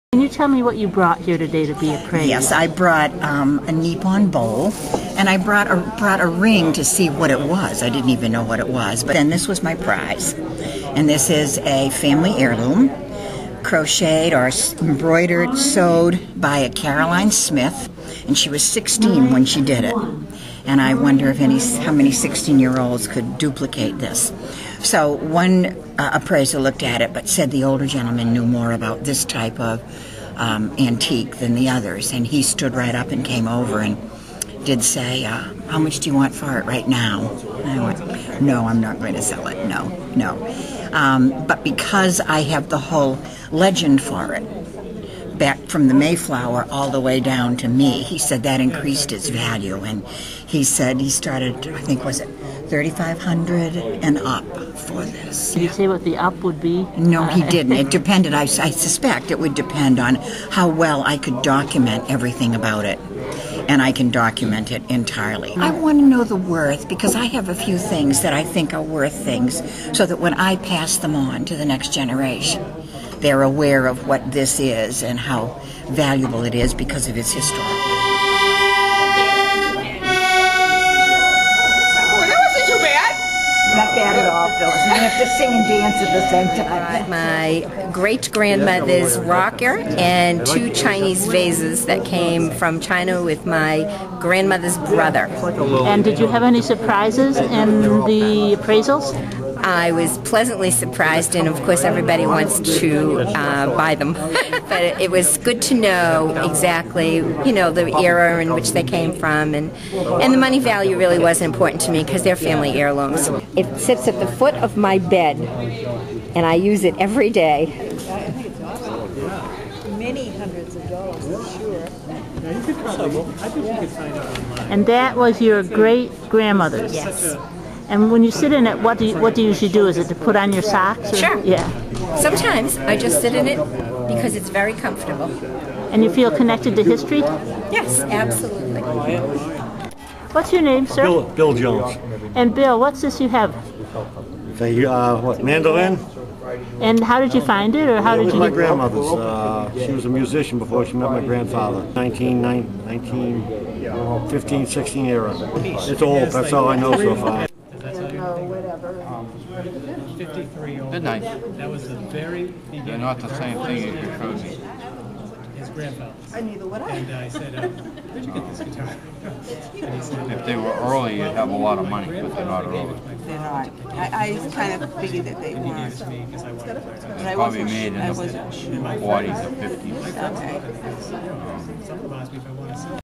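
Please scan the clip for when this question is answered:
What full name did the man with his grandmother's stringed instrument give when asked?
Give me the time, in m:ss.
2:21.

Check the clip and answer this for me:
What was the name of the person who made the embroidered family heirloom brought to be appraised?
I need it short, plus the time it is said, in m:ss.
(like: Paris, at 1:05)
Caroline Smith, at 0:16.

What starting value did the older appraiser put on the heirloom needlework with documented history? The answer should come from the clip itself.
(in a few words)
3500.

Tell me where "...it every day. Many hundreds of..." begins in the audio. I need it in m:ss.
1:56.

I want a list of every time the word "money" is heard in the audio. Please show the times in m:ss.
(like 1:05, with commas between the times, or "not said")
1:50, 2:51.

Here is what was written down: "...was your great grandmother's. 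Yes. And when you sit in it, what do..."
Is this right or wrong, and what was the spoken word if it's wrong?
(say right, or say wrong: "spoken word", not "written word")
right.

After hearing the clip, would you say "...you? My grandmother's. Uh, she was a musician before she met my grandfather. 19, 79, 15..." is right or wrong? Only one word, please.
wrong.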